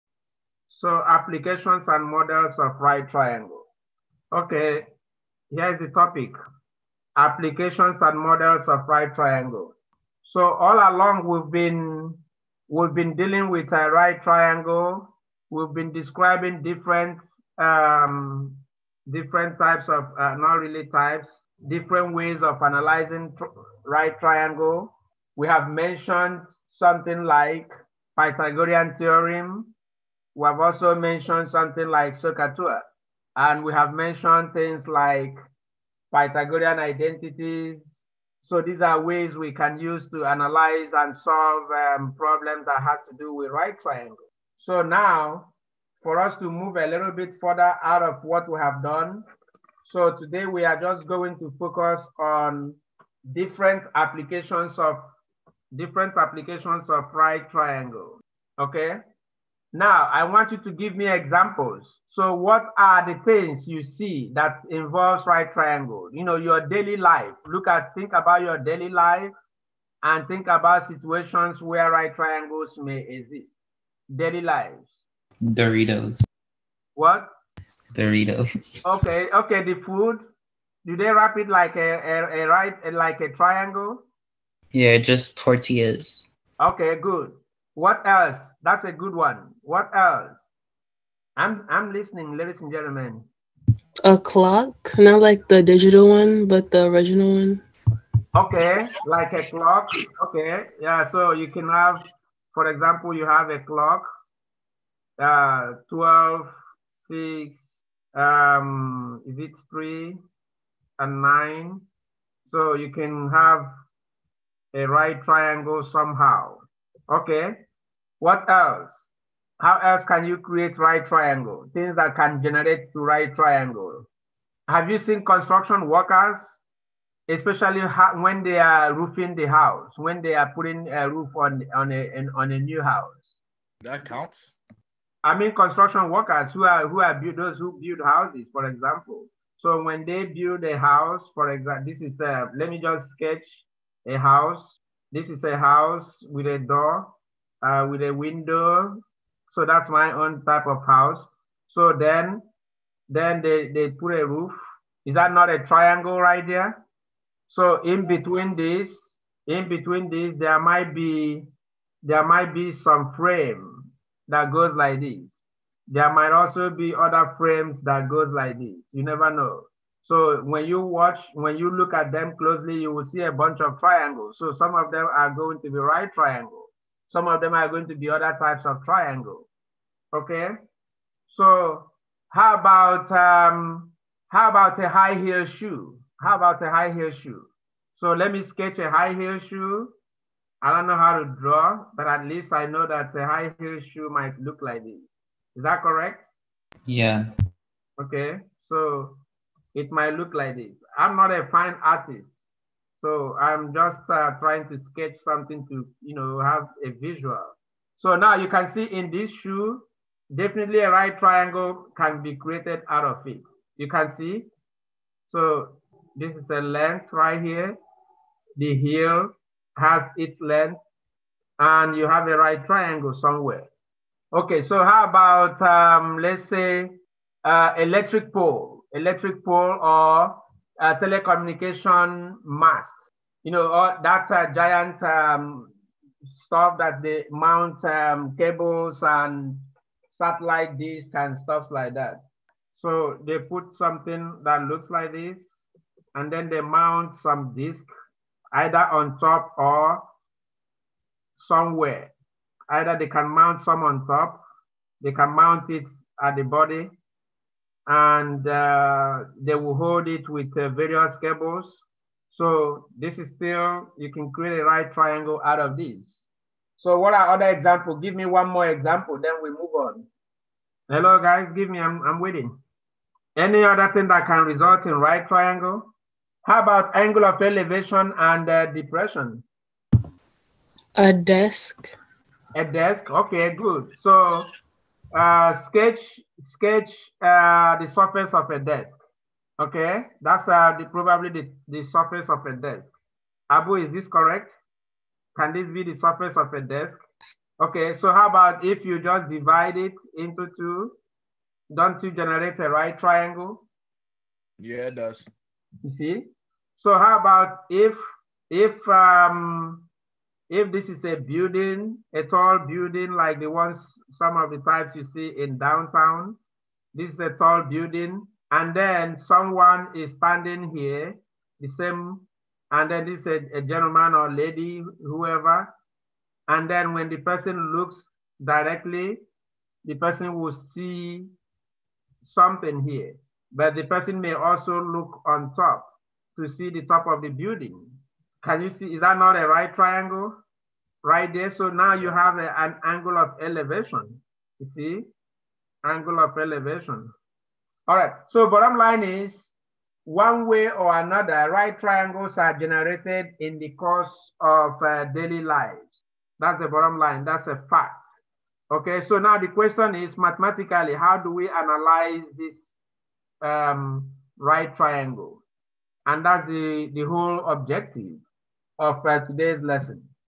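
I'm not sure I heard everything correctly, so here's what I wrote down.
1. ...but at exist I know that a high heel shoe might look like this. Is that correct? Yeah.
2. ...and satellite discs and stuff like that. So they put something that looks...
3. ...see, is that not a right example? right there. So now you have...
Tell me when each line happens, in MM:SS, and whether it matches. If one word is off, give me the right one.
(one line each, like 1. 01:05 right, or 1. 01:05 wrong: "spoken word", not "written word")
1. 03:11 wrong: "least", not "exist"
2. 03:59 right
3. 05:38 wrong: "triangle", not "example".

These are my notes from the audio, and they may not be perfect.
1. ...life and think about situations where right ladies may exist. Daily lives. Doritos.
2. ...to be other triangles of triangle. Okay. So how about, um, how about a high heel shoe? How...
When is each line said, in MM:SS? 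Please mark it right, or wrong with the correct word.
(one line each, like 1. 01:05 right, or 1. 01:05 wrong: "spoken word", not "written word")
1. 01:08 wrong: "triangles", not "ladies"
2. 02:57 wrong: "types", not "triangles".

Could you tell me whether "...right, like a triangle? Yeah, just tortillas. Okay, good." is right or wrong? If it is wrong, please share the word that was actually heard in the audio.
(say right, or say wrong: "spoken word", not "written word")
right.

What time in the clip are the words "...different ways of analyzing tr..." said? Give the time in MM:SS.
00:21.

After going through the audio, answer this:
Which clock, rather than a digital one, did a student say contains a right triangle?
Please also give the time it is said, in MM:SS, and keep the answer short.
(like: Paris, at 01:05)
the original one, at 01:36.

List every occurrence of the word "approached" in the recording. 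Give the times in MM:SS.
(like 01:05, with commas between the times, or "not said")
not said.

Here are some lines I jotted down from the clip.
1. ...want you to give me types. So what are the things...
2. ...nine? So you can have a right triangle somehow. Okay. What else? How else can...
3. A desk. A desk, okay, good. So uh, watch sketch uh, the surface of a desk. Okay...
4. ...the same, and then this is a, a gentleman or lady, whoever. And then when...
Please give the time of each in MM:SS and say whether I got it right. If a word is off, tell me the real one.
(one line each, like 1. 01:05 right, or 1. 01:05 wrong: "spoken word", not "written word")
1. 01:00 wrong: "examples", not "types"
2. 01:51 right
3. 04:40 wrong: "sketch", not "watch"
4. 05:21 right.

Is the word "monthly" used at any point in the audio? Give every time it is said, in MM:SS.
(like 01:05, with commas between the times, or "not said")
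not said.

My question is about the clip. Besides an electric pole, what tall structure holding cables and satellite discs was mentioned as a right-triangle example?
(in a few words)
telecommunication mast.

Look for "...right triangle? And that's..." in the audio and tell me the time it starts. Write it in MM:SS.
06:04.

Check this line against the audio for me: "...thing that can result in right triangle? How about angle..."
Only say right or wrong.
right.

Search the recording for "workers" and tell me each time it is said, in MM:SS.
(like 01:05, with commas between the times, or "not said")
02:05, 02:16.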